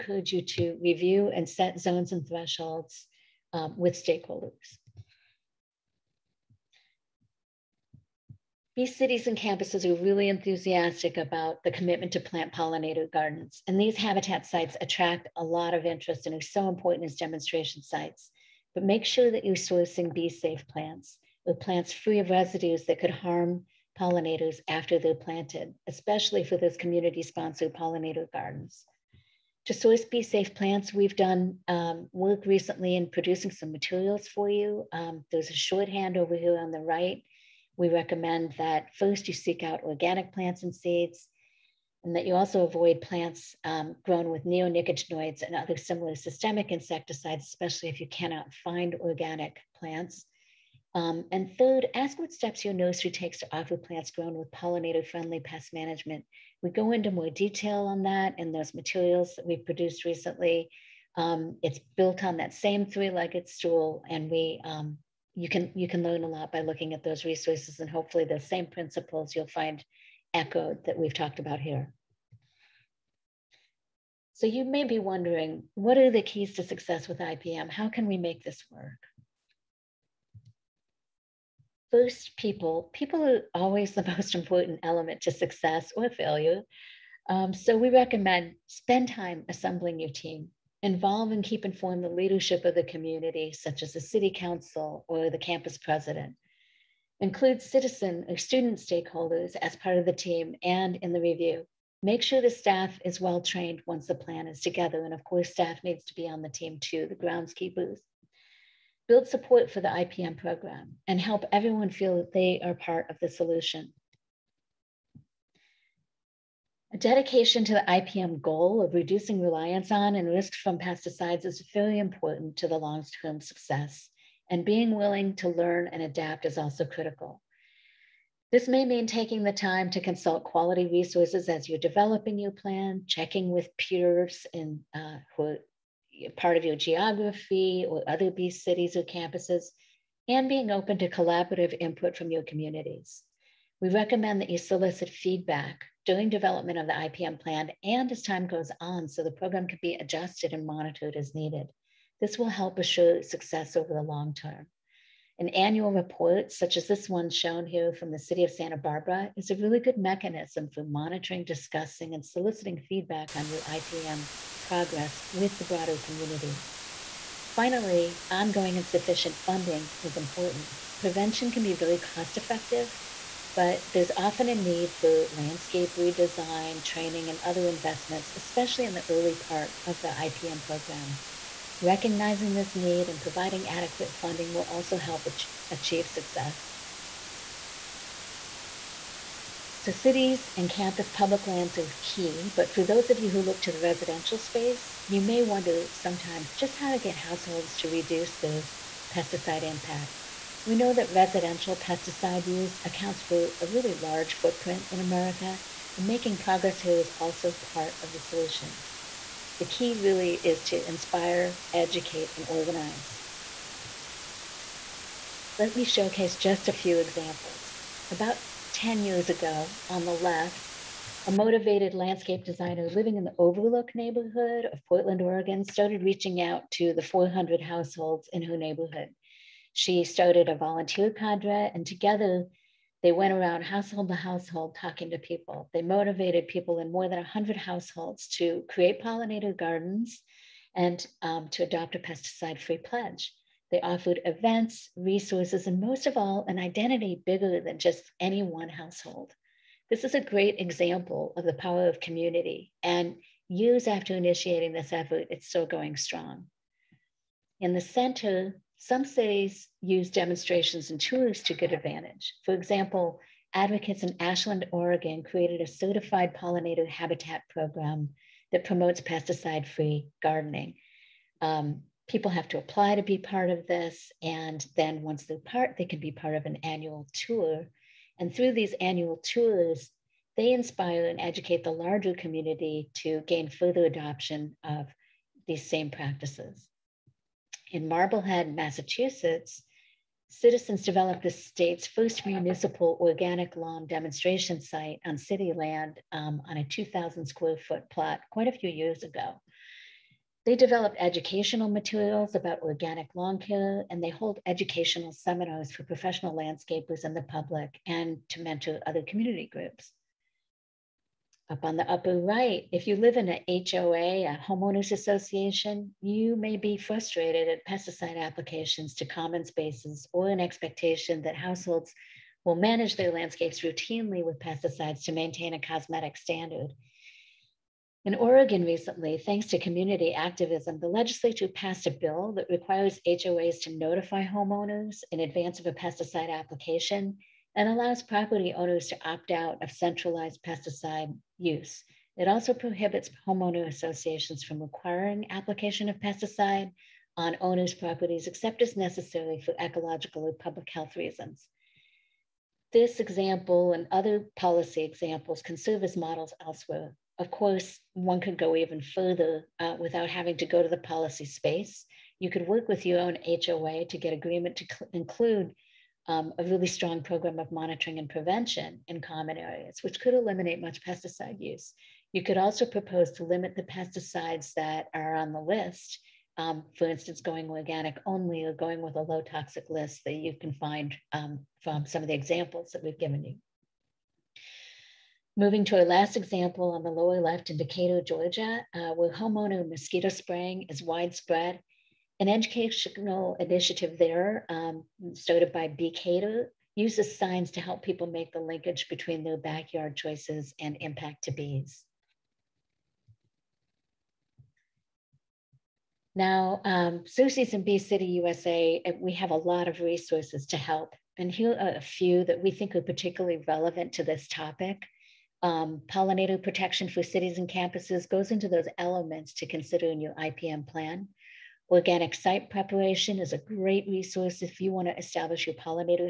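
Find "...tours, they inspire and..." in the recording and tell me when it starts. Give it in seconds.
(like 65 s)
279 s.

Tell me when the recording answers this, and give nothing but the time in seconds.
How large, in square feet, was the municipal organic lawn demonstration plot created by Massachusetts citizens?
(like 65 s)
296 s.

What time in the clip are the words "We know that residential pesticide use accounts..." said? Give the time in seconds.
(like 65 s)
200 s.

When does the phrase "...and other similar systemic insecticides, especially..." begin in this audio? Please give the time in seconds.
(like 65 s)
45 s.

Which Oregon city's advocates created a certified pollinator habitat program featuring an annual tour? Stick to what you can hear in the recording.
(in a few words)
Ashland.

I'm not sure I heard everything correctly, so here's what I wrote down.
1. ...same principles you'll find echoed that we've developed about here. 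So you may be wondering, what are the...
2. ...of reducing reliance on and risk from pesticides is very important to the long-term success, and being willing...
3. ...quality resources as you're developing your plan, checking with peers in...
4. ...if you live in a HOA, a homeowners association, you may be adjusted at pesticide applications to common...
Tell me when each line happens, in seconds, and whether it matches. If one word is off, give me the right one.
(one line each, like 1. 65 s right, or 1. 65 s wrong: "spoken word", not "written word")
1. 68 s wrong: "talked", not "developed"
2. 118 s right
3. 130 s right
4. 312 s wrong: "frustrated", not "adjusted".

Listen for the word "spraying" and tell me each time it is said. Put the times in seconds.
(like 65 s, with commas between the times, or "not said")
390 s.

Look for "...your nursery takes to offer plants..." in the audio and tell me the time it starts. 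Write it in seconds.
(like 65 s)
52 s.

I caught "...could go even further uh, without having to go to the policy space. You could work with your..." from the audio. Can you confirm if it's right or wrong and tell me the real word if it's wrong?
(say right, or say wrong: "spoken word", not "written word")
right.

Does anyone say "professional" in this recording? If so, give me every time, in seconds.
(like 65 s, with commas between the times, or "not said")
305 s.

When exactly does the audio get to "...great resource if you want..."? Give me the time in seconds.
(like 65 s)
423 s.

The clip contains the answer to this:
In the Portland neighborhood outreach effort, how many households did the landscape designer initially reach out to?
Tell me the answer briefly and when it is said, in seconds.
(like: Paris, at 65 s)
400, at 227 s.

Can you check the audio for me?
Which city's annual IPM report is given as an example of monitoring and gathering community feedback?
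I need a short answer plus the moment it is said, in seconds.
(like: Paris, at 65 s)
Santa Barbara, at 158 s.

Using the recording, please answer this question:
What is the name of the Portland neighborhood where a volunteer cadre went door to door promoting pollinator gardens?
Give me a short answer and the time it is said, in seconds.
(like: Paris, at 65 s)
Overlook, at 223 s.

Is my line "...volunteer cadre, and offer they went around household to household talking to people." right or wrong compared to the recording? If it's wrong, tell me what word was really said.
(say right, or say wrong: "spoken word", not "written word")
wrong: "together", not "offer".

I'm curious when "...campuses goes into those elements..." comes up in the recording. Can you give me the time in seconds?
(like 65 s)
417 s.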